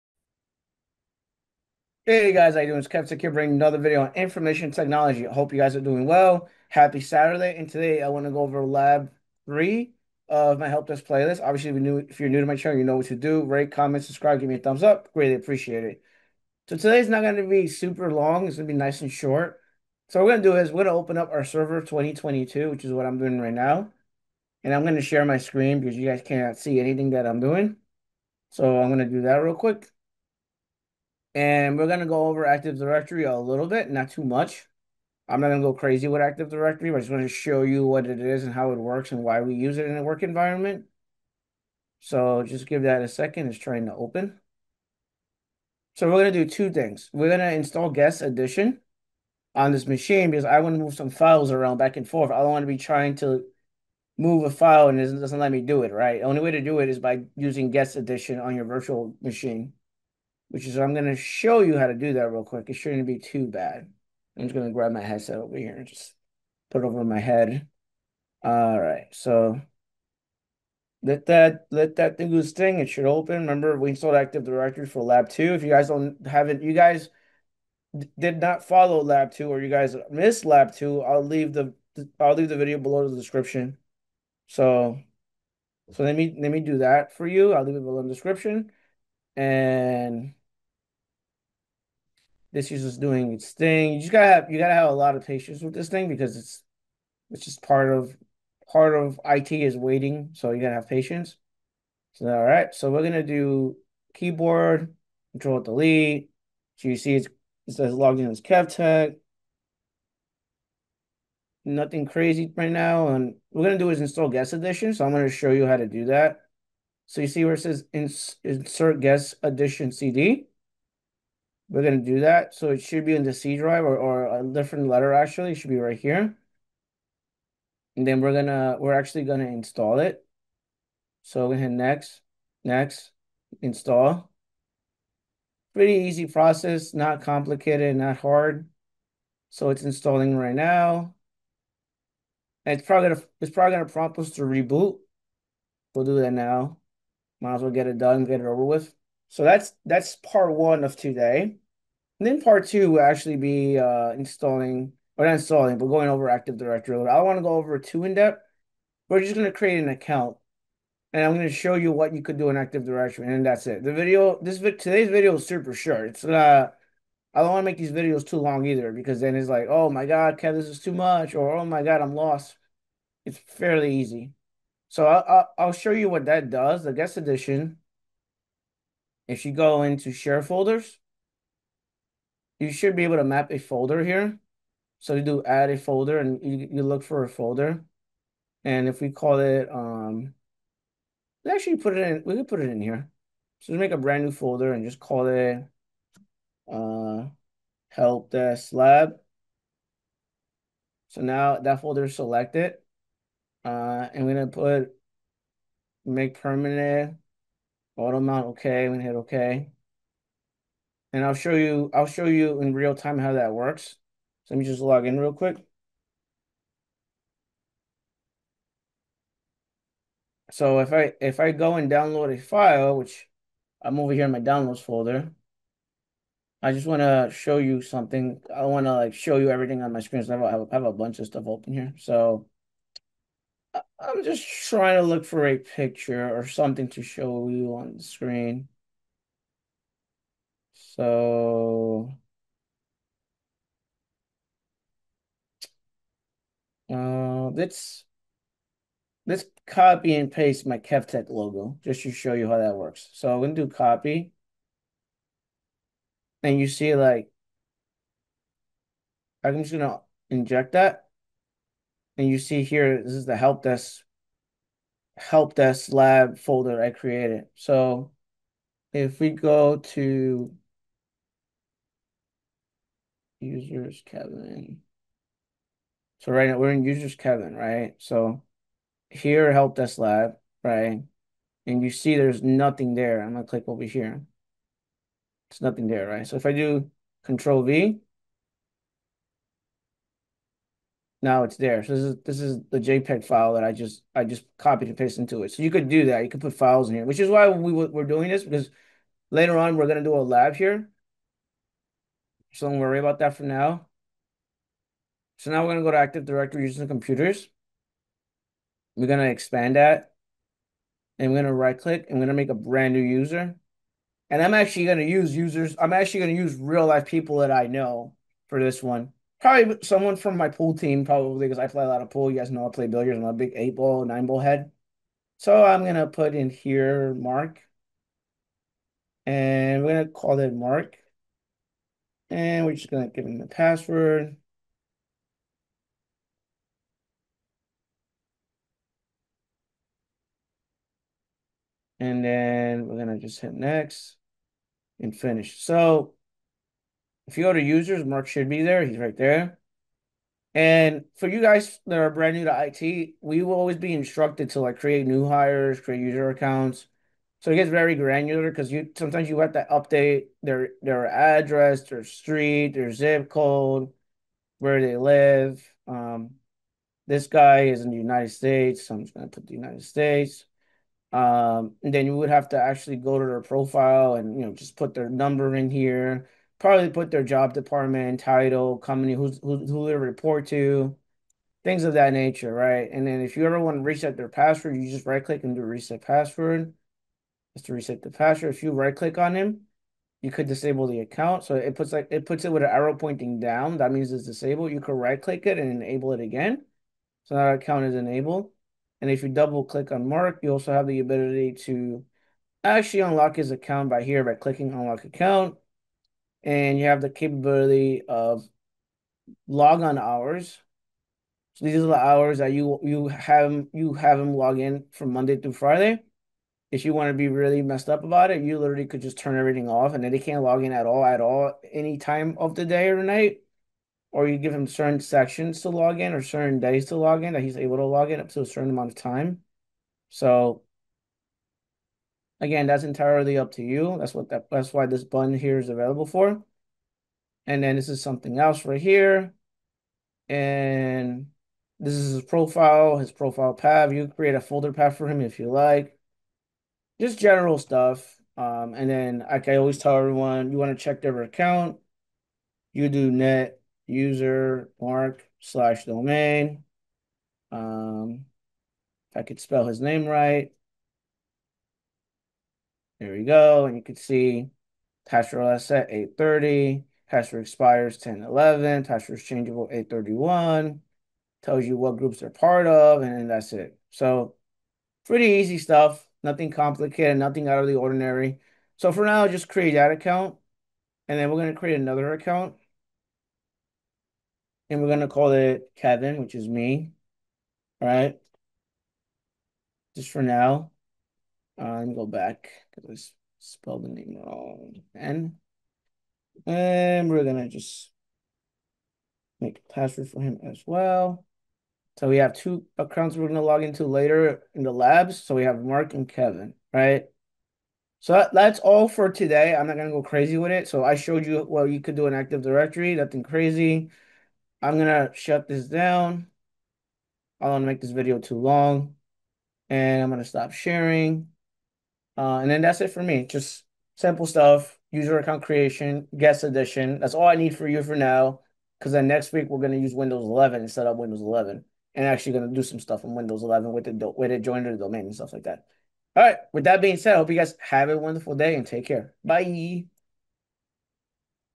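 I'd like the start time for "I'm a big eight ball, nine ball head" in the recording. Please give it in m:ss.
5:23.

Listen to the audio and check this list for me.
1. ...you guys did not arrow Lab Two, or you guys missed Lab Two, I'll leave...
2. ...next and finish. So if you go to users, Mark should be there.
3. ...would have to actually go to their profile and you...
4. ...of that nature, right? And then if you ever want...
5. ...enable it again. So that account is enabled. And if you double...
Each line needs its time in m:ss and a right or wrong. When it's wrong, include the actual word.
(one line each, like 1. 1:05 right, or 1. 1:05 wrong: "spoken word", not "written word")
1. 1:16 wrong: "follow", not "arrow"
2. 5:43 right
3. 6:12 right
4. 6:21 right
5. 6:35 right.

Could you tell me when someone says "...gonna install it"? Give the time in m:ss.
2:09.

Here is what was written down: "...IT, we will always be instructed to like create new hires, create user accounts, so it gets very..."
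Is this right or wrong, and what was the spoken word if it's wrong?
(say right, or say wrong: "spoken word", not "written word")
right.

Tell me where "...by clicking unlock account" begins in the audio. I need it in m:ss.
6:44.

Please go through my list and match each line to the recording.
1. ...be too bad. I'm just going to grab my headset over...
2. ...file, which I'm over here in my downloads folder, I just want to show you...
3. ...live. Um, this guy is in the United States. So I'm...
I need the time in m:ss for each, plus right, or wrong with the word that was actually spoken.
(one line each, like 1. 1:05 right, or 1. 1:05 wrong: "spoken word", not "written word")
1. 1:03 right
2. 3:42 right
3. 6:04 right.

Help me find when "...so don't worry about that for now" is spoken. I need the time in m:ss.
5:02.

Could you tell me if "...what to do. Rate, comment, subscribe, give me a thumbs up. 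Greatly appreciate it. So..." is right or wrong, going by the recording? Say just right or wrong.
right.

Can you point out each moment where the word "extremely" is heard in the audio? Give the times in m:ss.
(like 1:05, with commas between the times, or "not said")
not said.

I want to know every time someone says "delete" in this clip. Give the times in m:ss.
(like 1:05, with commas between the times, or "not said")
1:45.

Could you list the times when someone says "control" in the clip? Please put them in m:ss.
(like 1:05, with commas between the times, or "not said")
1:45, 4:47.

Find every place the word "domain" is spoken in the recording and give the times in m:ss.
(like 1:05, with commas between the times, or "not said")
7:35, 8:54.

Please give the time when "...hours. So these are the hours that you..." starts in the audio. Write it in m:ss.
6:49.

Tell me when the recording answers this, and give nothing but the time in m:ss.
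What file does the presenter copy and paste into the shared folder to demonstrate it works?
4:10.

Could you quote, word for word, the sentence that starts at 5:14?
And I'm actually going to use users.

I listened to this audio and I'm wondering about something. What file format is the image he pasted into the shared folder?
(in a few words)
JPEG.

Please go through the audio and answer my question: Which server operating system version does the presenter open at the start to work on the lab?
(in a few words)
Server 2022.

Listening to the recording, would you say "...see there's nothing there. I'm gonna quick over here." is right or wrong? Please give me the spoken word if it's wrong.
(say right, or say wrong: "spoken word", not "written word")
wrong: "click", not "quick".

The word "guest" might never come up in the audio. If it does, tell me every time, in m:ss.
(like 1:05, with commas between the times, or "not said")
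0:47, 0:57, 1:54, 1:58, 2:56, 8:46.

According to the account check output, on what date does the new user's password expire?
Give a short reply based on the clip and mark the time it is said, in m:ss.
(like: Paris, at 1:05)
10/11, at 7:47.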